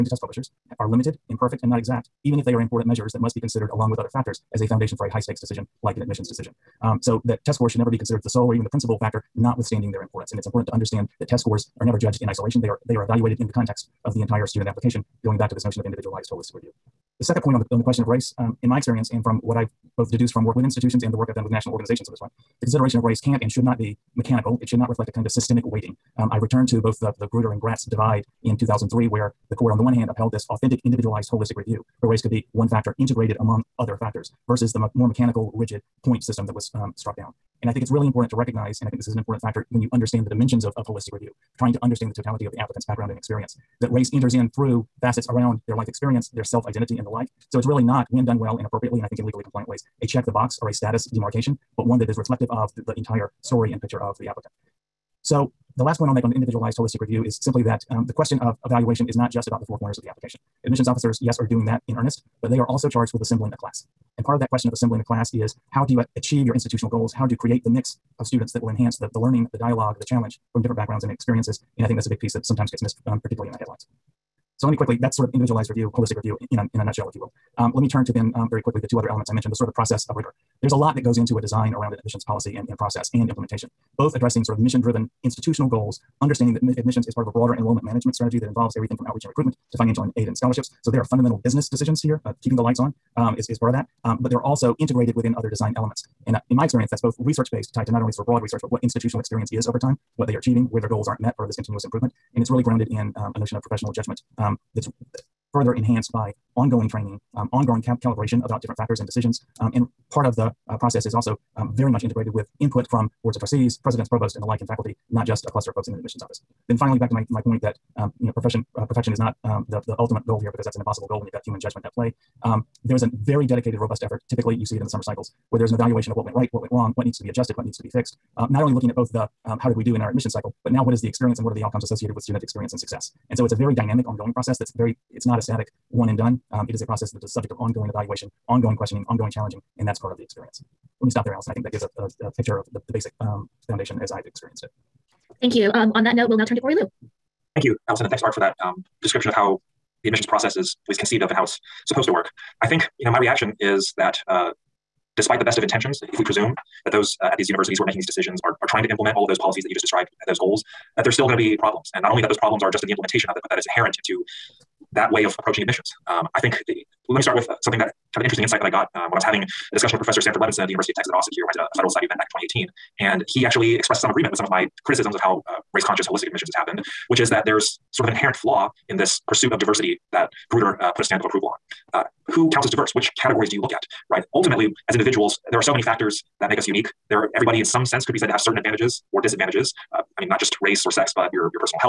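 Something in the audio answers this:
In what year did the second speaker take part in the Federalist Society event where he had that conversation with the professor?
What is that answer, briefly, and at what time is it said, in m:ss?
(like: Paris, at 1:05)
2018, at 2:52.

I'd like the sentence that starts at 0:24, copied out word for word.
It should not reflect a kind of systemic weighting.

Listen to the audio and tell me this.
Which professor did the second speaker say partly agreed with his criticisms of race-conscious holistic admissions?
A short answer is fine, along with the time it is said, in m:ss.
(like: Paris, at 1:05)
Sanford Levinson, at 2:50.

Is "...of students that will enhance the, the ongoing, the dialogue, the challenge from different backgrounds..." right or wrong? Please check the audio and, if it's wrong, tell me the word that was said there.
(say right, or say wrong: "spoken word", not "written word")
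wrong: "learning", not "ongoing".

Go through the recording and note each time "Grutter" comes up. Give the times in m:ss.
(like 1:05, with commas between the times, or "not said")
0:27, 3:00.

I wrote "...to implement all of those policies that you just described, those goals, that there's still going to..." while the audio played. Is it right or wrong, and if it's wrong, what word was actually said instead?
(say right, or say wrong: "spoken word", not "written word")
right.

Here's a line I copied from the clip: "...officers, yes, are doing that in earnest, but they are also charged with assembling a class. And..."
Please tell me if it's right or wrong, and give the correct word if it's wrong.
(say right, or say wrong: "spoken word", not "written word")
right.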